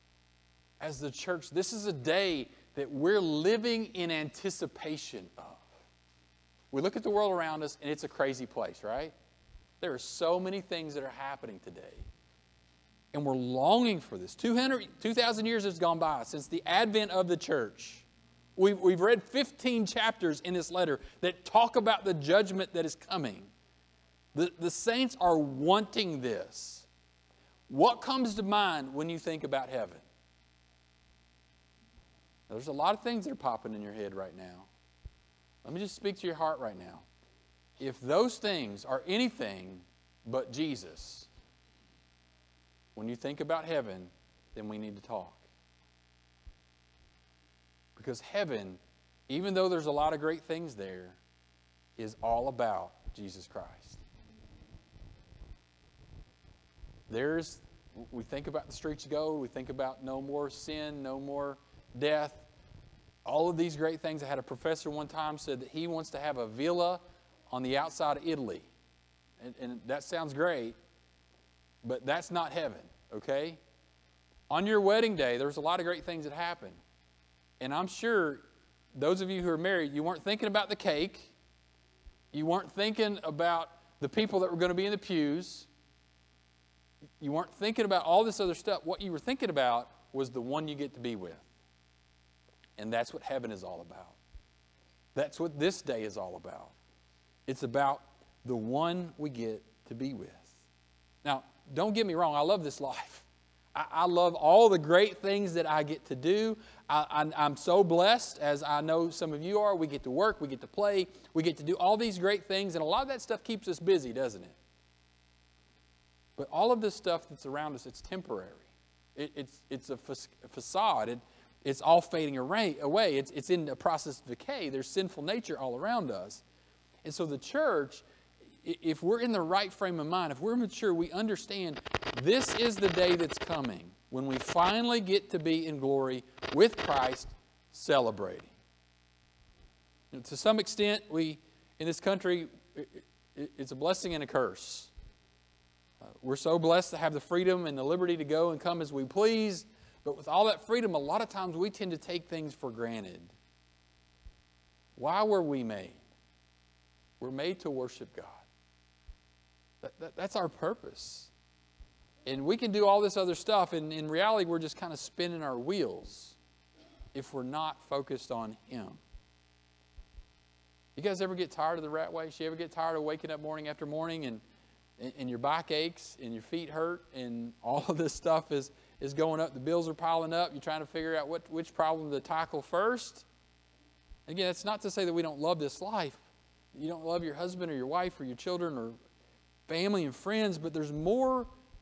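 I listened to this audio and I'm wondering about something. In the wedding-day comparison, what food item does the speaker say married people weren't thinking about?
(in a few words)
The cake.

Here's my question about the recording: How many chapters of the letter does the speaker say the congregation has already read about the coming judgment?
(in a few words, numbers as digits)
15.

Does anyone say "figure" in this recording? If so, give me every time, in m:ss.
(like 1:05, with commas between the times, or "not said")
3:00.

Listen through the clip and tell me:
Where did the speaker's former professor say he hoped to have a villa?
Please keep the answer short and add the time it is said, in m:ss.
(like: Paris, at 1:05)
Outside of Italy, at 1:07.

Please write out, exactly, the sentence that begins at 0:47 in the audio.
Because heaven, even though there's a lot of great things there, is all about Jesus Christ.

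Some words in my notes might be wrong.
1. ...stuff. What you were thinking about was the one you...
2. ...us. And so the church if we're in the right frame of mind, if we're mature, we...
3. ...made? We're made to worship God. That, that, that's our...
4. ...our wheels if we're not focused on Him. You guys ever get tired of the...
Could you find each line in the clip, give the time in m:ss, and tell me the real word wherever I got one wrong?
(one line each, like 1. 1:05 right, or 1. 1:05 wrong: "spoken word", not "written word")
1. 1:28 right
2. 2:06 right
3. 2:35 right
4. 2:45 right.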